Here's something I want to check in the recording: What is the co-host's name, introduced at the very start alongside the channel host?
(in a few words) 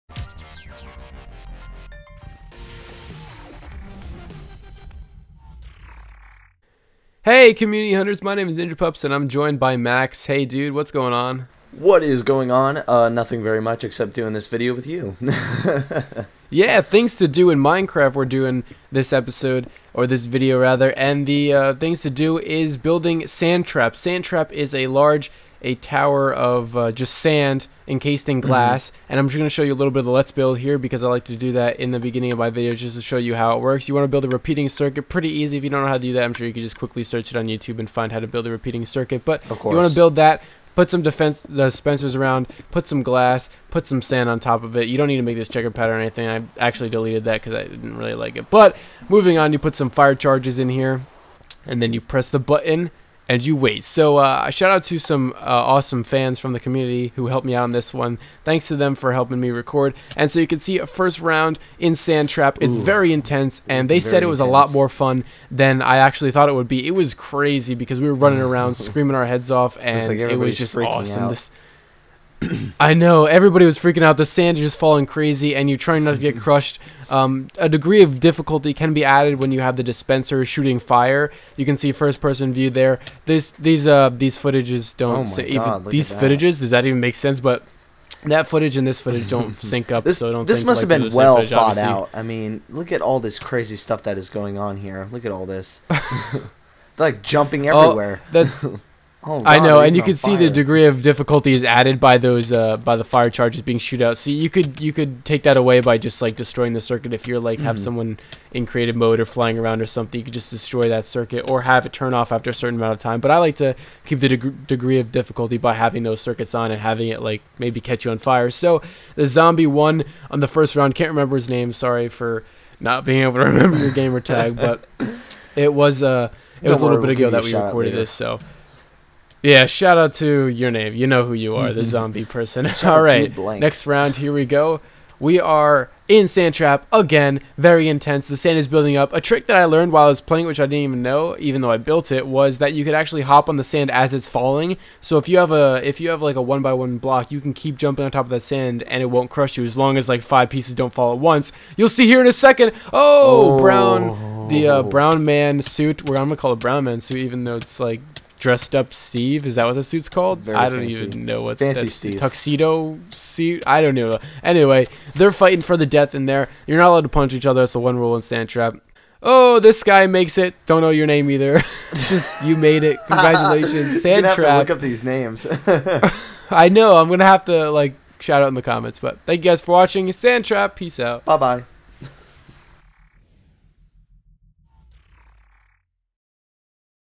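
Max.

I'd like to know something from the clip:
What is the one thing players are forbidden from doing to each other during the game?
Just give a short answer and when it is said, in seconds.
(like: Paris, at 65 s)
Punch each other, at 167 s.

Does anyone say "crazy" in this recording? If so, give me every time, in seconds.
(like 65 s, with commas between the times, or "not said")
67 s, 75 s, 93 s.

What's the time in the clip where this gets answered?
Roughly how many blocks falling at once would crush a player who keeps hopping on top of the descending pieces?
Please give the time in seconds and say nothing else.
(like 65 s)
150 s.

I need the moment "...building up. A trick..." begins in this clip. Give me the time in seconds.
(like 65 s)
138 s.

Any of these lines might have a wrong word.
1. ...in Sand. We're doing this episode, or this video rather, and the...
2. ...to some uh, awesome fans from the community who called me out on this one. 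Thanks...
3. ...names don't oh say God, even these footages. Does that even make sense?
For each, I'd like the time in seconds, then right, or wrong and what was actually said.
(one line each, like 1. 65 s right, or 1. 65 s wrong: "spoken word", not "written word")
1. 17 s wrong: "Minecraft", not "Sand"
2. 54 s wrong: "helped", not "called"
3. 84 s wrong: "footages", not "names".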